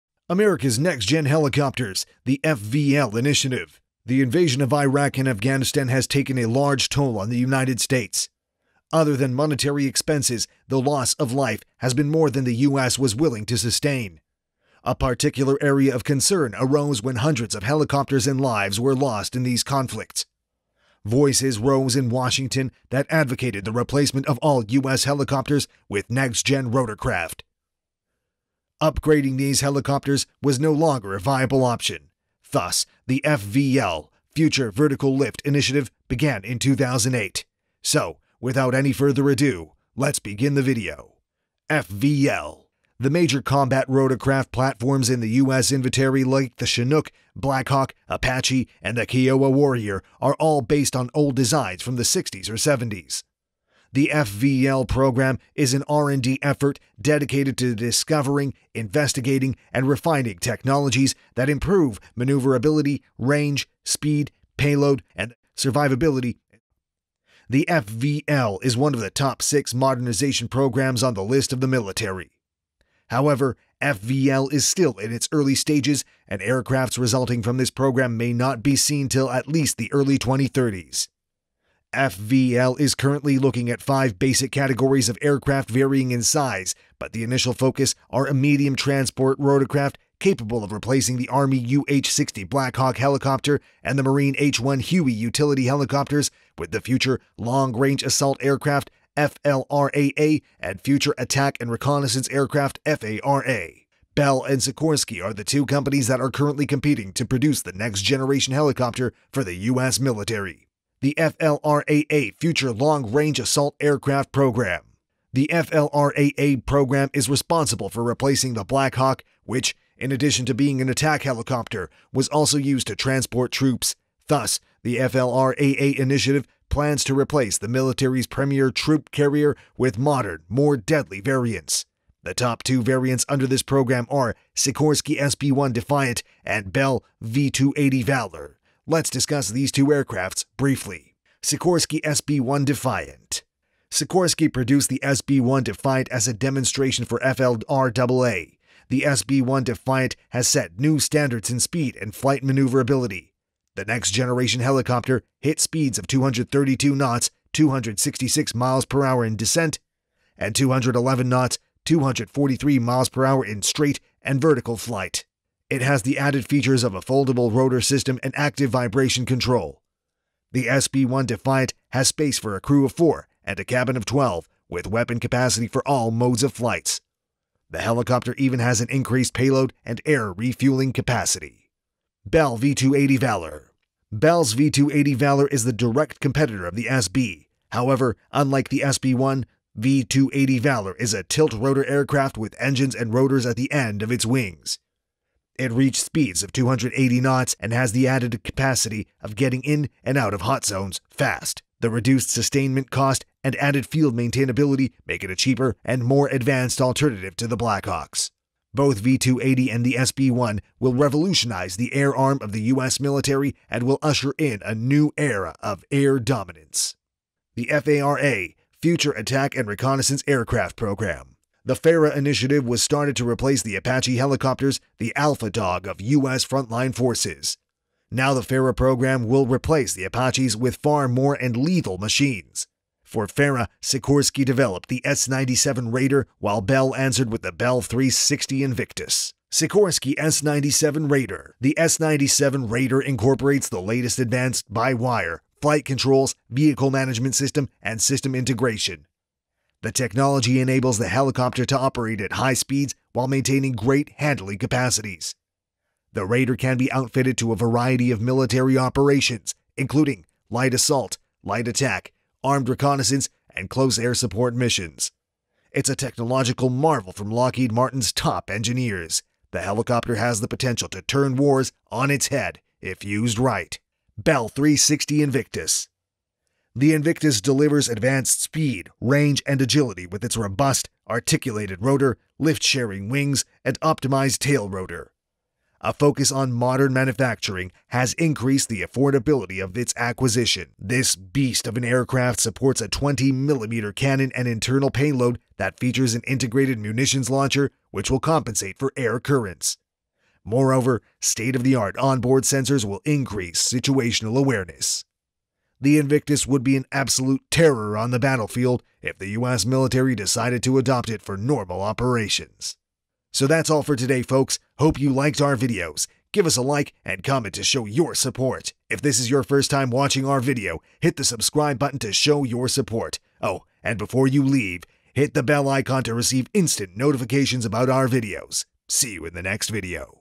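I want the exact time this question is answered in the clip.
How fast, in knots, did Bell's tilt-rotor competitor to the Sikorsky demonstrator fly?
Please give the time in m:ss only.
3:16.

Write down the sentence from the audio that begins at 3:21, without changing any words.
The reduced sustainment cost and added field maintainability make it a cheaper and more advanced alternative to the Blackhawks.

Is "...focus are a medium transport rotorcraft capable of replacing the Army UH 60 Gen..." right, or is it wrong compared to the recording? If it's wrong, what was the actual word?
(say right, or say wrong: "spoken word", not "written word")
wrong: "Black", not "Gen".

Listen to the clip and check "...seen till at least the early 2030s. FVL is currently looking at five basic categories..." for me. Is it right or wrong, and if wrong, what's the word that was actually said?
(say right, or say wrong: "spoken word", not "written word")
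right.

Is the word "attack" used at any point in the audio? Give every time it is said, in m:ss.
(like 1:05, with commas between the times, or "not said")
1:41, 2:00, 3:39, 4:21.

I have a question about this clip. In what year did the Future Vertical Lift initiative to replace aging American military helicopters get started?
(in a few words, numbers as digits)
2008.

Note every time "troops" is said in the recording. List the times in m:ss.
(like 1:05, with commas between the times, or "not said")
2:03, 2:08.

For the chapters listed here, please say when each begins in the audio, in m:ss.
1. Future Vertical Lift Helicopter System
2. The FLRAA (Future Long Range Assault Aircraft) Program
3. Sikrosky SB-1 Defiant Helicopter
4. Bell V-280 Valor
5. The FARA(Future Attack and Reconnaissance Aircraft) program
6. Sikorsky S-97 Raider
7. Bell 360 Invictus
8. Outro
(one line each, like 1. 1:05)
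1. 0:42
2. 1:51
3. 2:21
4. 3:02
5. 3:38
6. 3:59
7. 4:34
8. 5:13.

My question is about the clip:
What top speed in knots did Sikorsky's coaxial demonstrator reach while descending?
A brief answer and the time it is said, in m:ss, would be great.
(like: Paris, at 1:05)
232 knots, at 2:36.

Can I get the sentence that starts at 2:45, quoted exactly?
It has the added features of a foldable rotor system and active vibration control.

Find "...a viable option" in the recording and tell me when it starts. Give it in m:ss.
0:31.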